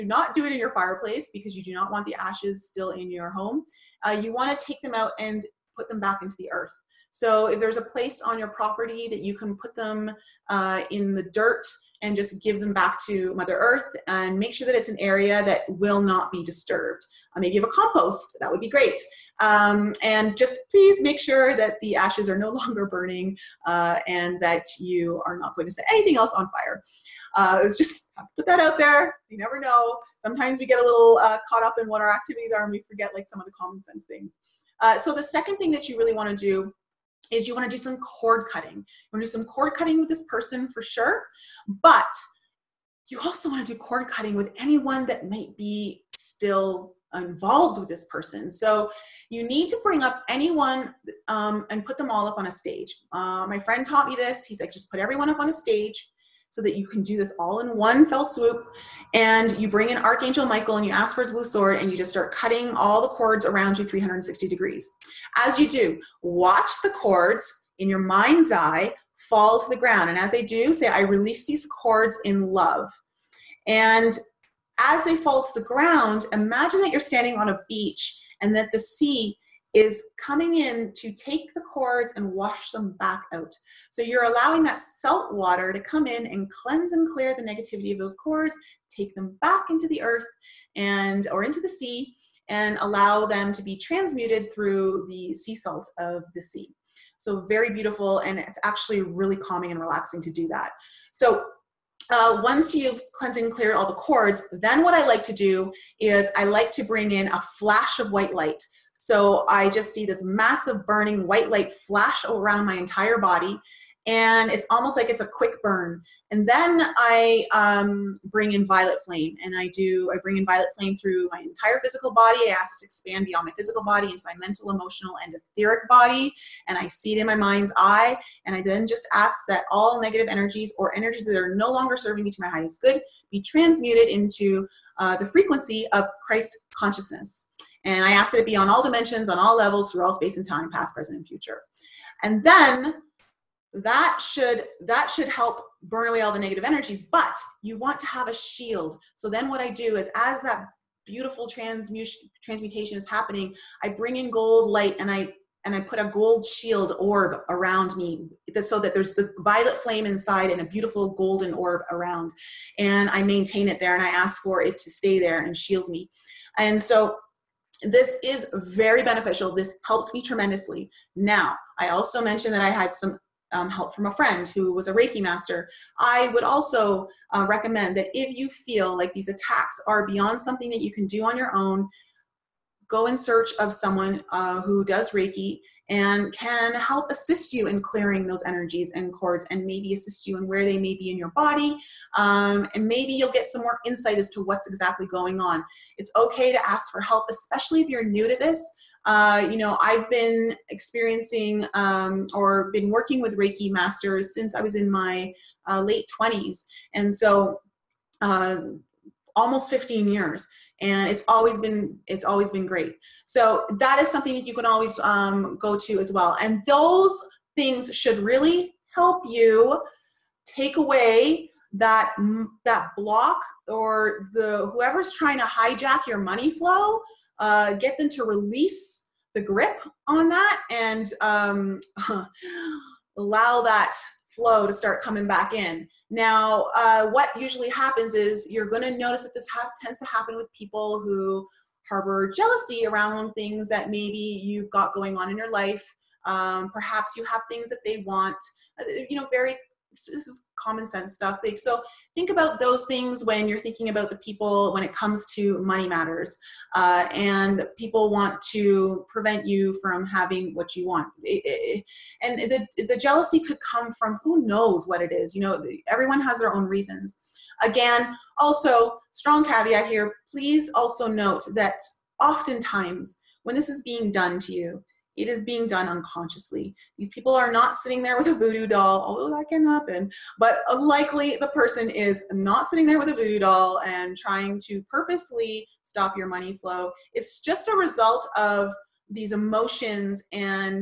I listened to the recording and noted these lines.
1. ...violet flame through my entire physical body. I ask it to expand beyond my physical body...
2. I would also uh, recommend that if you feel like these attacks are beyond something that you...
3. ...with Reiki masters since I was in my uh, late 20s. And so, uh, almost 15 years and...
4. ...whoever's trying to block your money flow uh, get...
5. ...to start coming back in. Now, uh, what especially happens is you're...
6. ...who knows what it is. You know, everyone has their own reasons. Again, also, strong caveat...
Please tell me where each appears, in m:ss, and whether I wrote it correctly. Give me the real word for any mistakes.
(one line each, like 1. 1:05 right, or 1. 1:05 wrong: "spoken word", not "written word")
1. 2:00 right
2. 2:55 right
3. 3:23 right
4. 3:44 wrong: "hijack", not "block"
5. 3:54 wrong: "usually", not "especially"
6. 4:24 right.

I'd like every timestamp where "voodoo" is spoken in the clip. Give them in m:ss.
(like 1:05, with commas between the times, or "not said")
4:38, 4:43.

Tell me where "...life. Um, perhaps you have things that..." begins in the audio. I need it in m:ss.
4:05.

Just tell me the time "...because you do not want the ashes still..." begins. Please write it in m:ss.
0:01.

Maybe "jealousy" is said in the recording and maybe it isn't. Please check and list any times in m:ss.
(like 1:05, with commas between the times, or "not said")
4:02, 4:22.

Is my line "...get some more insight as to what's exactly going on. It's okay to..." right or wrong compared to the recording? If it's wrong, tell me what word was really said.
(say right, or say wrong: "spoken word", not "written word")
right.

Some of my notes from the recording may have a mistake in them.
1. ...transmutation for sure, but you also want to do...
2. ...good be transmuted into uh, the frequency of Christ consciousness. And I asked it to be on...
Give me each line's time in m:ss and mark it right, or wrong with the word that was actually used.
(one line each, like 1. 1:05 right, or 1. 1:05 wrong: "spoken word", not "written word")
1. 0:40 wrong: "person", not "transmutation"
2. 2:12 right.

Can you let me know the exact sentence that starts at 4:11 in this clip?
Like, so think about those things when you're thinking about the people when it comes to money matters.